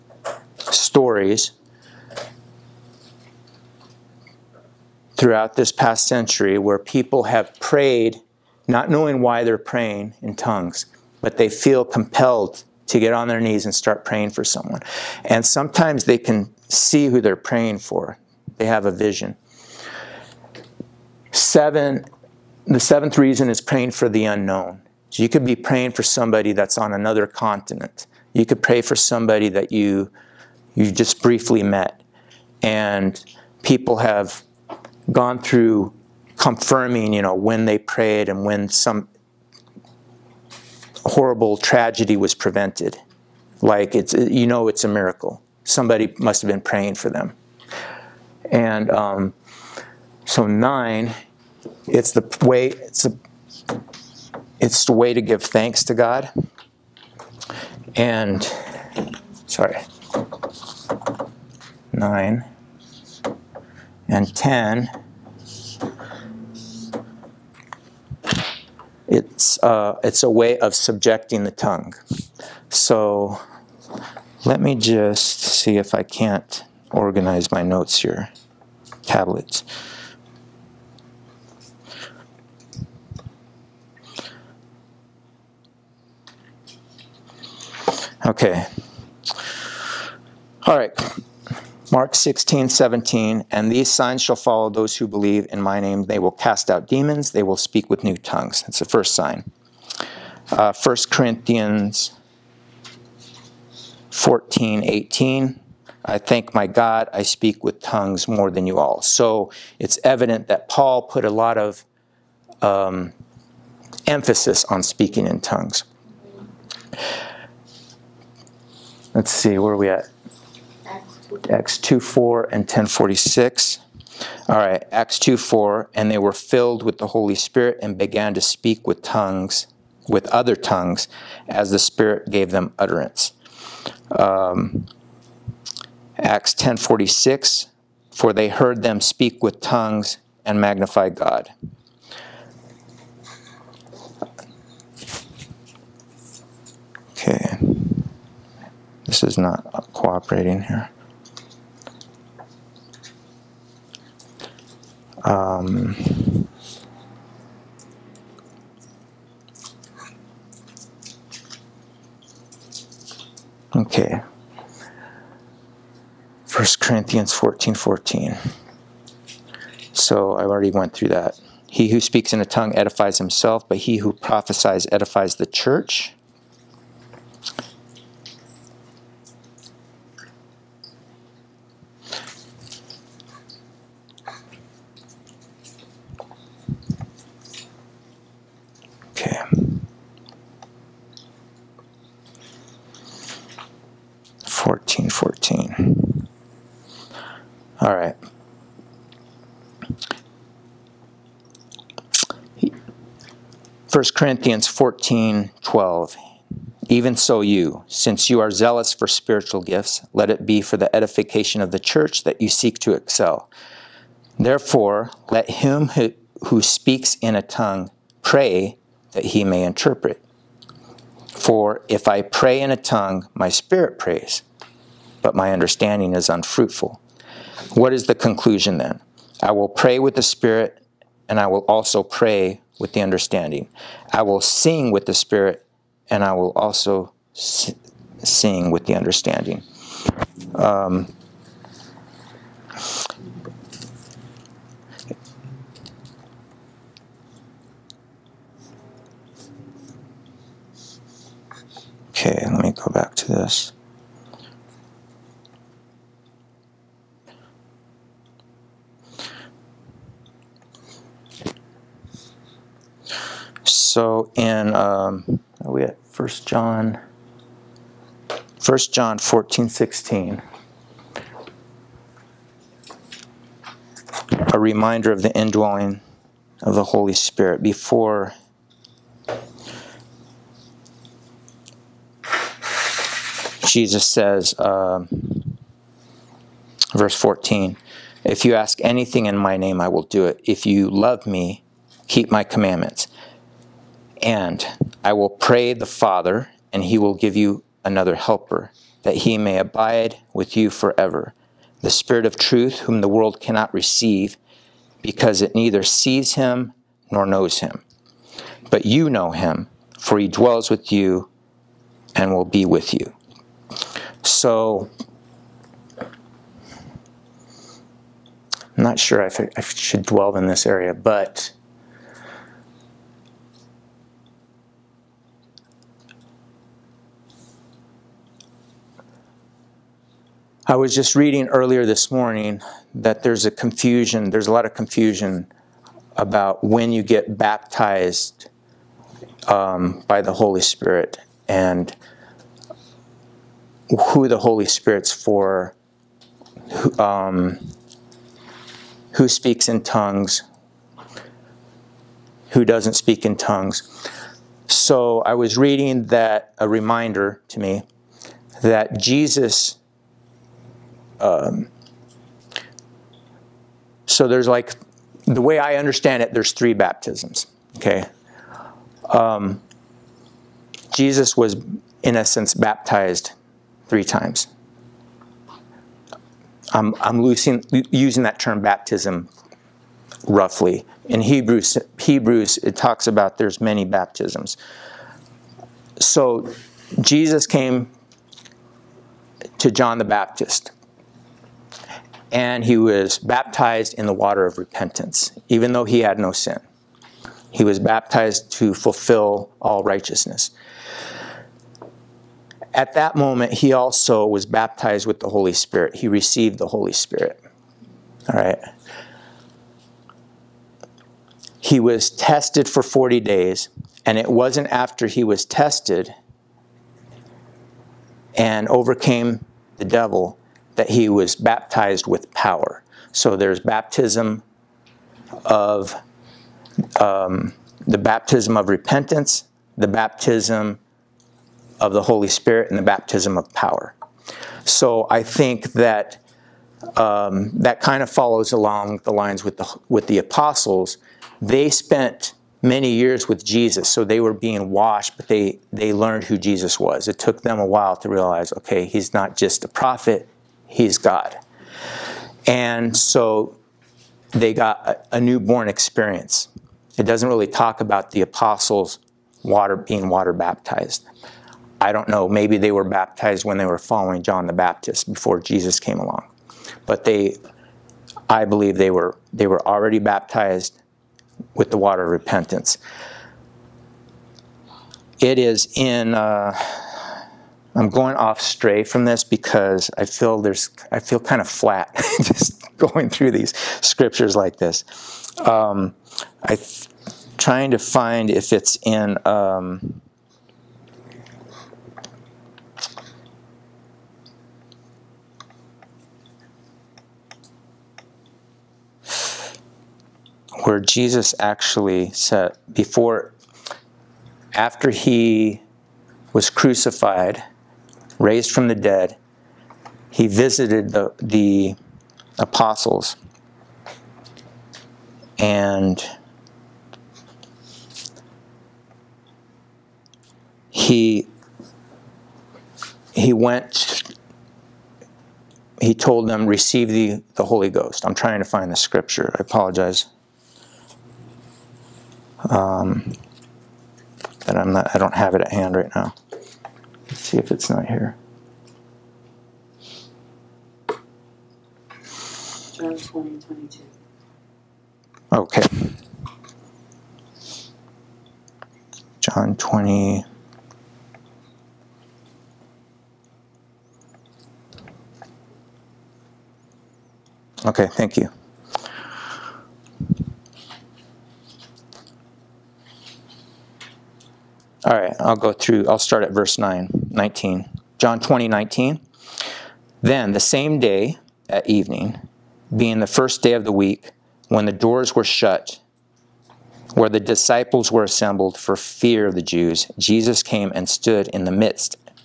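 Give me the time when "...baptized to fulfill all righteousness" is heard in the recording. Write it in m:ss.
6:37.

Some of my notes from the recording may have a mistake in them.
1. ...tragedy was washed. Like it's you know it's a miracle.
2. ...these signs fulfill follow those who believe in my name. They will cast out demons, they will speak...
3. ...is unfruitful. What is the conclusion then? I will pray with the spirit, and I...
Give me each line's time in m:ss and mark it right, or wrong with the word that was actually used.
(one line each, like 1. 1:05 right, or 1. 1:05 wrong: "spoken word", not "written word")
1. 0:41 wrong: "prevented", not "washed"
2. 1:33 wrong: "shall", not "fulfill"
3. 3:46 right.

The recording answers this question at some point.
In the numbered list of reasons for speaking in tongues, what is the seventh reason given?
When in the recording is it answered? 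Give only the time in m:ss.
0:23.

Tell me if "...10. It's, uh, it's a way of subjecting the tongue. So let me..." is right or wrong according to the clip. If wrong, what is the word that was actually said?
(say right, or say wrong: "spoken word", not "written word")
right.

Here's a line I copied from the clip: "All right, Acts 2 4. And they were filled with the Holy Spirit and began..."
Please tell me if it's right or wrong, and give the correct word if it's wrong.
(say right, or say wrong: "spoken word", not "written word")
right.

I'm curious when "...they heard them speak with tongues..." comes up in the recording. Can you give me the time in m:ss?
2:18.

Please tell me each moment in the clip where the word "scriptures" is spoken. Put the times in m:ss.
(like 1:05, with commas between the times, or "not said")
8:03, 8:48.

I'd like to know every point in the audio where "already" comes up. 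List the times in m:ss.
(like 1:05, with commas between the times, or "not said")
2:50, 7:49.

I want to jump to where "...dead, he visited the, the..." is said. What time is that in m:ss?
8:28.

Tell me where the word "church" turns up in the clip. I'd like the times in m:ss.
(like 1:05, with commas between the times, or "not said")
2:55, 3:31.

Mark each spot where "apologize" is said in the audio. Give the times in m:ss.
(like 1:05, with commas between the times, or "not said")
8:49.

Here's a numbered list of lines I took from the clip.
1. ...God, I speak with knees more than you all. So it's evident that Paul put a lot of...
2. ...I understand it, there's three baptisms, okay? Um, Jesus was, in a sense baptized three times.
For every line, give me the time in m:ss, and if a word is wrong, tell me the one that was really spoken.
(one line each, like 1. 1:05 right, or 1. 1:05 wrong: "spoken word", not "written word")
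1. 1:46 wrong: "tongues", not "knees"
2. 6:05 right.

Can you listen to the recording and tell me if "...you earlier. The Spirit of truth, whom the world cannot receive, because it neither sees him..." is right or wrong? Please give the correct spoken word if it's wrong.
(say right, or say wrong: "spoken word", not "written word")
wrong: "forever", not "earlier".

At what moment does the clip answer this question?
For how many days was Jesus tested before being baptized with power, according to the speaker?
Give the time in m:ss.
6:52.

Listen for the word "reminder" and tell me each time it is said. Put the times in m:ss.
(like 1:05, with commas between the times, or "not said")
4:34, 5:56.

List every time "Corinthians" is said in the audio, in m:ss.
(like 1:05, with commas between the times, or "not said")
1:41, 2:46, 3:24.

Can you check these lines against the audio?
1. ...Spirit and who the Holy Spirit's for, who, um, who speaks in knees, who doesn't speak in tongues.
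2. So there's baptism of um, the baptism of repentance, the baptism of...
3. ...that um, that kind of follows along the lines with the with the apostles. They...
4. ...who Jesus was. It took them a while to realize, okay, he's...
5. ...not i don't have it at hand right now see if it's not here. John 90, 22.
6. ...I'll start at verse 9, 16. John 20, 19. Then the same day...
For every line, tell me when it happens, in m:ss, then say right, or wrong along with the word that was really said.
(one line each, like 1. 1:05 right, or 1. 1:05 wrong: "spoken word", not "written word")
1. 5:40 wrong: "tongues", not "knees"
2. 7:03 right
3. 7:15 right
4. 7:26 right
5. 8:54 wrong: "20", not "90"
6. 9:25 wrong: "19", not "16".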